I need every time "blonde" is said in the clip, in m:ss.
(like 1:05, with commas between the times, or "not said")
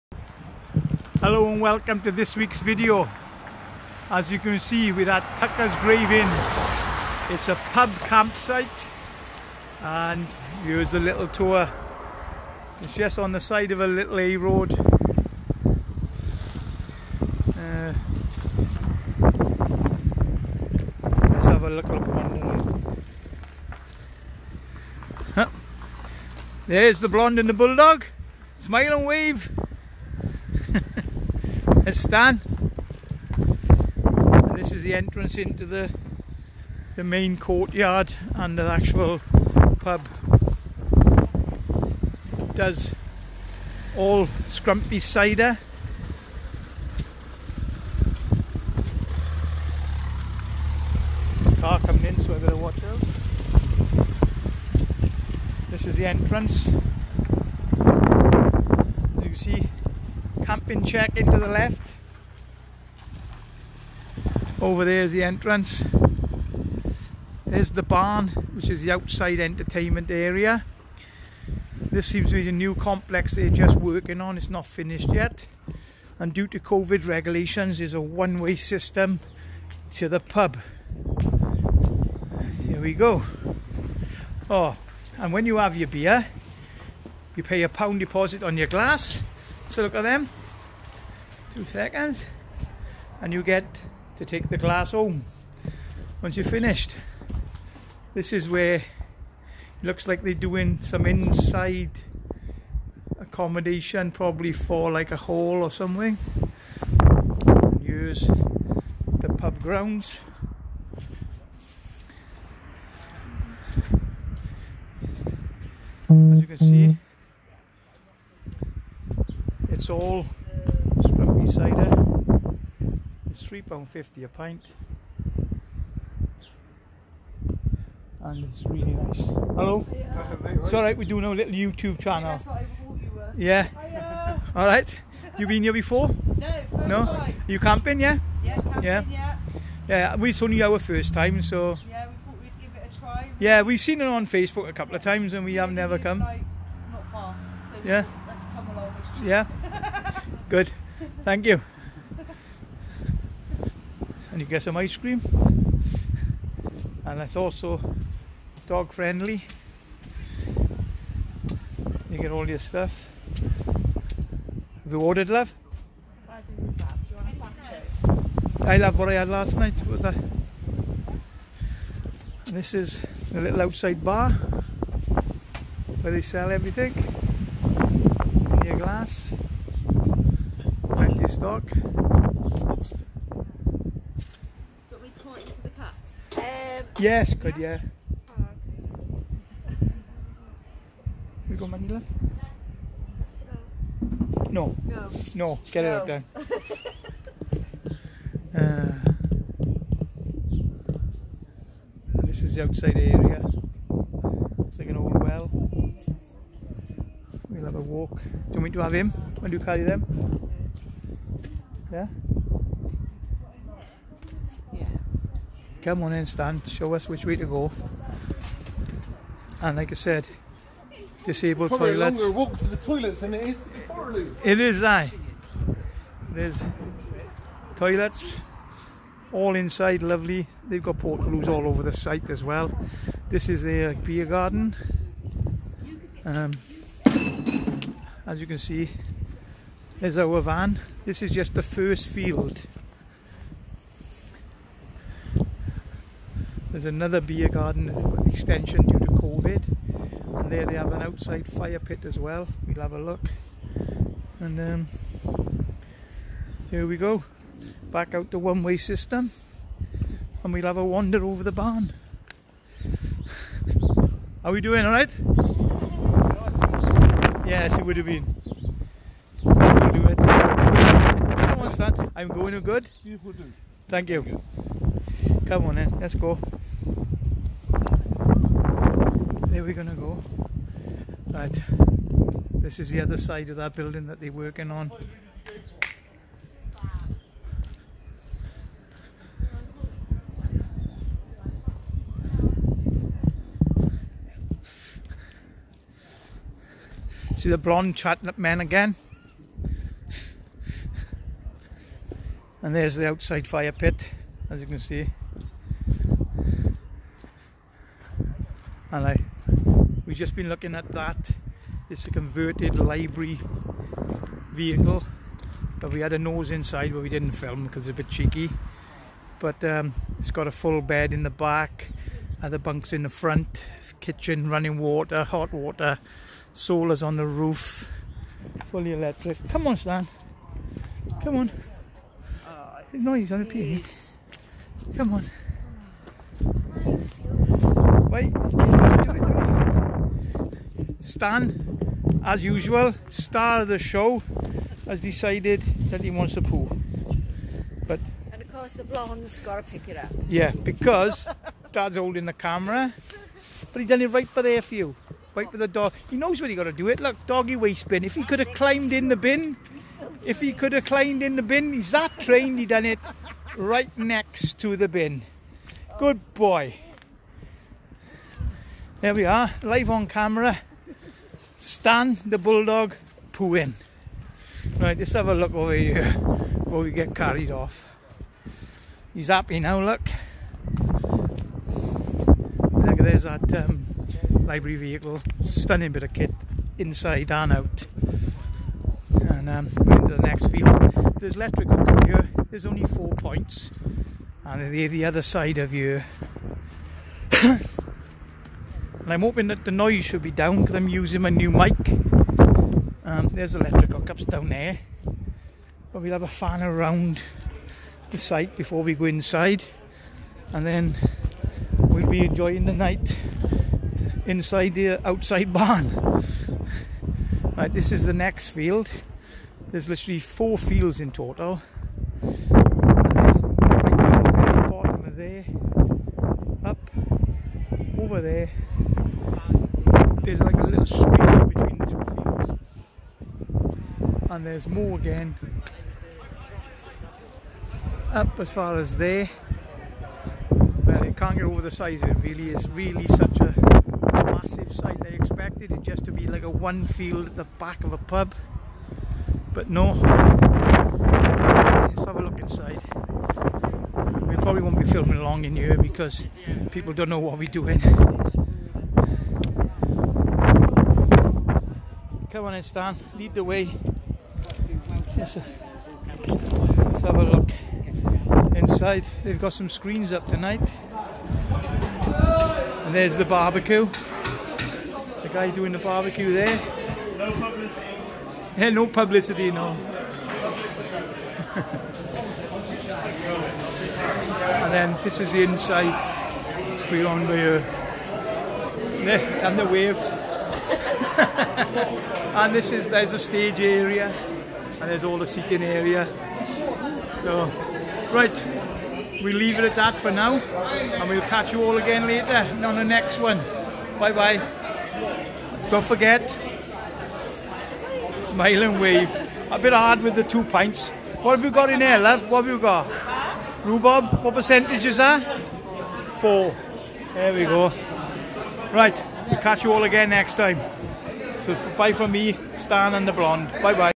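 0:27, 4:57, 5:48, 8:43.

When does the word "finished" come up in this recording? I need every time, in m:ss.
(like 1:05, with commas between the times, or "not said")
1:14, 1:36.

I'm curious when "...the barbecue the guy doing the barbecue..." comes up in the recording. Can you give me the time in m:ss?
7:53.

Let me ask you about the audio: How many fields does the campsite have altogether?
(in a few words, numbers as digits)
4.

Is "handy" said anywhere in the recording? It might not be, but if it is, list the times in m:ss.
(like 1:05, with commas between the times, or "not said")
not said.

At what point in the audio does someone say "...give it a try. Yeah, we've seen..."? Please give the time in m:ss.
2:22.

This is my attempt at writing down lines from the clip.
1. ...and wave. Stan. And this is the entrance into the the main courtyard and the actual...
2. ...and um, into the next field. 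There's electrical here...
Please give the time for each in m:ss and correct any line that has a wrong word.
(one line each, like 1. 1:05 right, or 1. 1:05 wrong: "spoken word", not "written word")
1. 0:28 right
2. 6:29 right.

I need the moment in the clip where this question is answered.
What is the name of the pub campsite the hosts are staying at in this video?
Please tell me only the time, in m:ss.
0:05.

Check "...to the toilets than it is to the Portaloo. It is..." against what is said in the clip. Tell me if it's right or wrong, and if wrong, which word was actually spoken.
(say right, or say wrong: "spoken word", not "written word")
right.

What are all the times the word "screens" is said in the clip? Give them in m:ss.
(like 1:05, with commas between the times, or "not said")
7:49.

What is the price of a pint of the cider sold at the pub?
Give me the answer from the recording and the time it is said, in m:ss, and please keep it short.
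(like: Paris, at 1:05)
£3.50, at 2:03.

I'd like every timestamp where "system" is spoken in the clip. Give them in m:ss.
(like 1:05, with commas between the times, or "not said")
1:18, 4:18.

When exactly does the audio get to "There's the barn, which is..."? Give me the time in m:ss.
1:07.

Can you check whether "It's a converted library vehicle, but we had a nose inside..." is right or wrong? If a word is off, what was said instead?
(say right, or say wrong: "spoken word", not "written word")
right.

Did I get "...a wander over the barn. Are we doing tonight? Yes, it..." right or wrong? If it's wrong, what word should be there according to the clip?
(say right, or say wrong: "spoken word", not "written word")
wrong: "alright", not "tonight".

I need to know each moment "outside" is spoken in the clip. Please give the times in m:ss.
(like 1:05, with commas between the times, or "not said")
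1:08, 2:53, 3:22, 4:11, 5:03, 6:55.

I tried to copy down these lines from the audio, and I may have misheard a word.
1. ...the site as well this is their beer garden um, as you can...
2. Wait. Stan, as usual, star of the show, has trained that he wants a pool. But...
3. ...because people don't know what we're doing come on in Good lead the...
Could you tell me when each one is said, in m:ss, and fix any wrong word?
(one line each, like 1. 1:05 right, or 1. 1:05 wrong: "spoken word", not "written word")
1. 3:51 right
2. 5:38 wrong: "decided", not "trained"
3. 7:35 wrong: "Stan", not "Good".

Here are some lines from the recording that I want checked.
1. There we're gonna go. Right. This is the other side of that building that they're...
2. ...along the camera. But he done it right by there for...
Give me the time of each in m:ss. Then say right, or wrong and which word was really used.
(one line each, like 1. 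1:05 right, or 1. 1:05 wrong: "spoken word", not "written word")
1. 4:39 right
2. 5:51 wrong: "holding", not "along".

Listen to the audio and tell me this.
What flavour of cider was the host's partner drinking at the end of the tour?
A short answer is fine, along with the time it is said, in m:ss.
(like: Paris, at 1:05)
Rhubarb, at 8:33.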